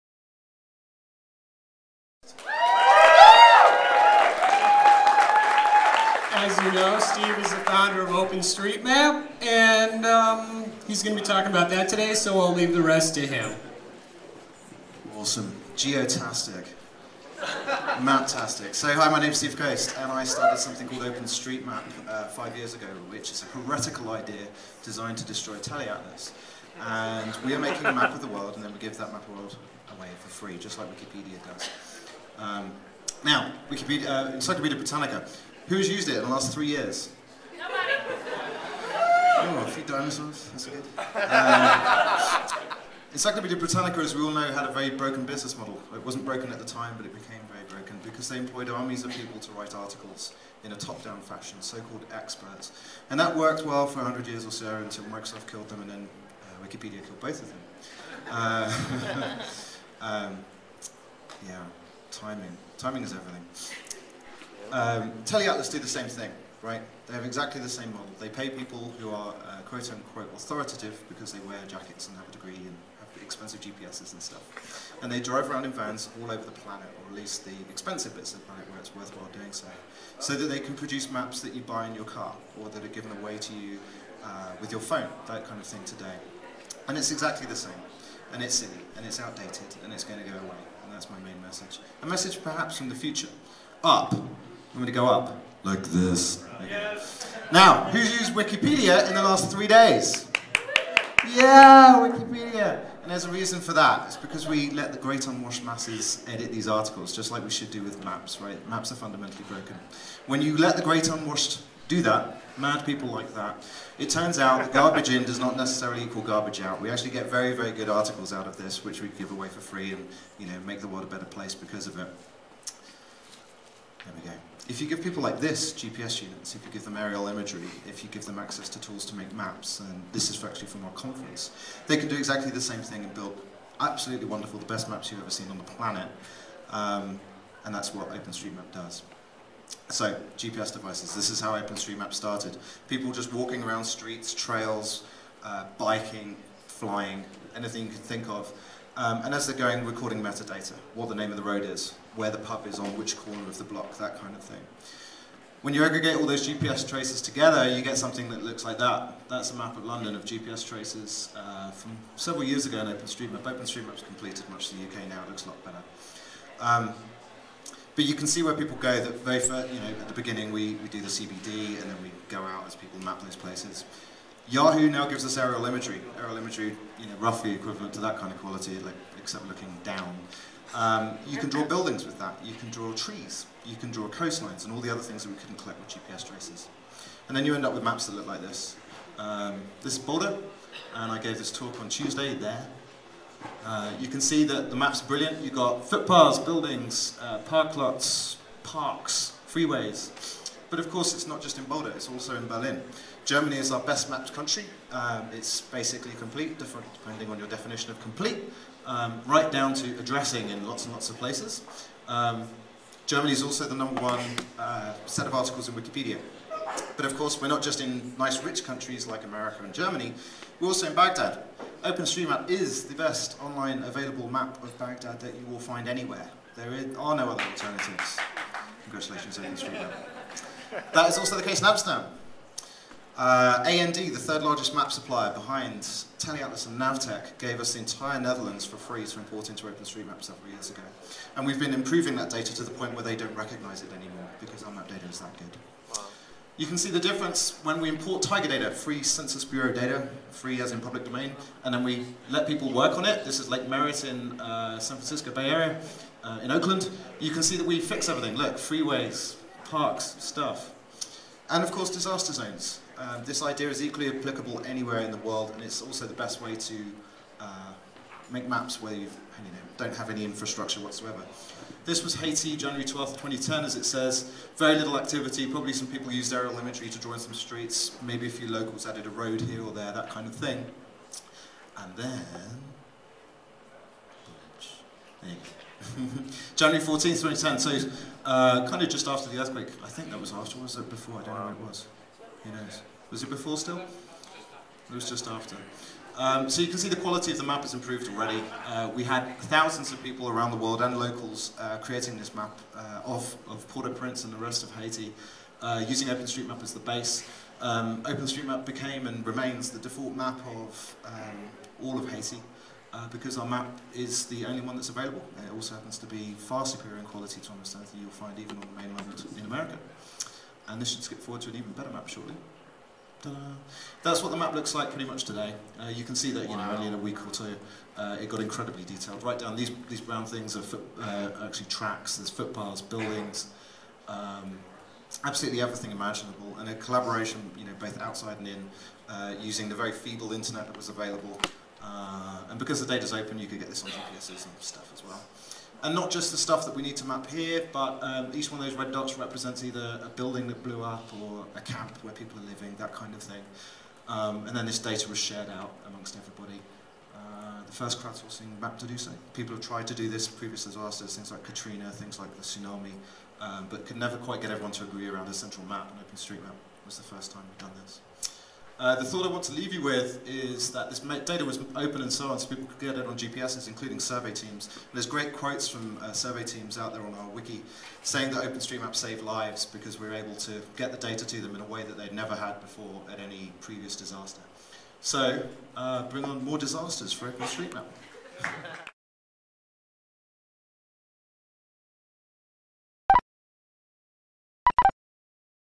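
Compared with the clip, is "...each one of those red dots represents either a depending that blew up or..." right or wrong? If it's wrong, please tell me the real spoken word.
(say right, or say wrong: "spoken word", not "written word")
wrong: "building", not "depending".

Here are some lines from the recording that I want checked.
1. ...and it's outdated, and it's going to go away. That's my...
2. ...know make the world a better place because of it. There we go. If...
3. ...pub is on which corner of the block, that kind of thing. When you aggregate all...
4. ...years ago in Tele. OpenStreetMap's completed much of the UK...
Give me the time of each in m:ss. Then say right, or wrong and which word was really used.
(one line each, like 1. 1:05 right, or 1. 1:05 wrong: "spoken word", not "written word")
1. 1:28 right
2. 2:00 right
3. 2:32 right
4. 2:42 wrong: "OpenStreetMap", not "Tele".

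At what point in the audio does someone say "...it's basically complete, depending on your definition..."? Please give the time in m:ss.
3:25.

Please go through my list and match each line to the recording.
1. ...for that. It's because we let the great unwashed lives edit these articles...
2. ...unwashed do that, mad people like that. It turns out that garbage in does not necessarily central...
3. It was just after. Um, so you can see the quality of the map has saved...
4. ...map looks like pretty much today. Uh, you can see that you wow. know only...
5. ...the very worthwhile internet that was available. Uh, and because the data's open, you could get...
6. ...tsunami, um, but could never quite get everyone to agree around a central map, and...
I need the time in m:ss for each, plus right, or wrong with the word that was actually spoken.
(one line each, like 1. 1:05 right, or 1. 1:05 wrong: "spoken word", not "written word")
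1. 1:43 wrong: "masses", not "lives"
2. 1:51 wrong: "equal", not "central"
3. 4:53 wrong: "improved", not "saved"
4. 5:24 right
5. 5:39 wrong: "feeble", not "worthwhile"
6. 6:02 right.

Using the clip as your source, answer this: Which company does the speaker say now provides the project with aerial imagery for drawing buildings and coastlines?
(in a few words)
Yahoo.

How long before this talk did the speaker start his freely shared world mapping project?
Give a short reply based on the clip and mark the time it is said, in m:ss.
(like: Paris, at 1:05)
5 years, at 0:22.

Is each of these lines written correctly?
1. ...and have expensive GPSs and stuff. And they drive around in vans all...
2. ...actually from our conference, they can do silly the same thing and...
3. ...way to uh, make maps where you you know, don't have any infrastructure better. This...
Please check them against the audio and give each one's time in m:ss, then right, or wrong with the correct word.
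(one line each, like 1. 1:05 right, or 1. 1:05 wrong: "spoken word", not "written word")
1. 1:12 right
2. 2:10 wrong: "exactly", not "silly"
3. 4:26 wrong: "whatsoever", not "better".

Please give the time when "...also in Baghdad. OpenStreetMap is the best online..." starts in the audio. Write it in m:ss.
3:40.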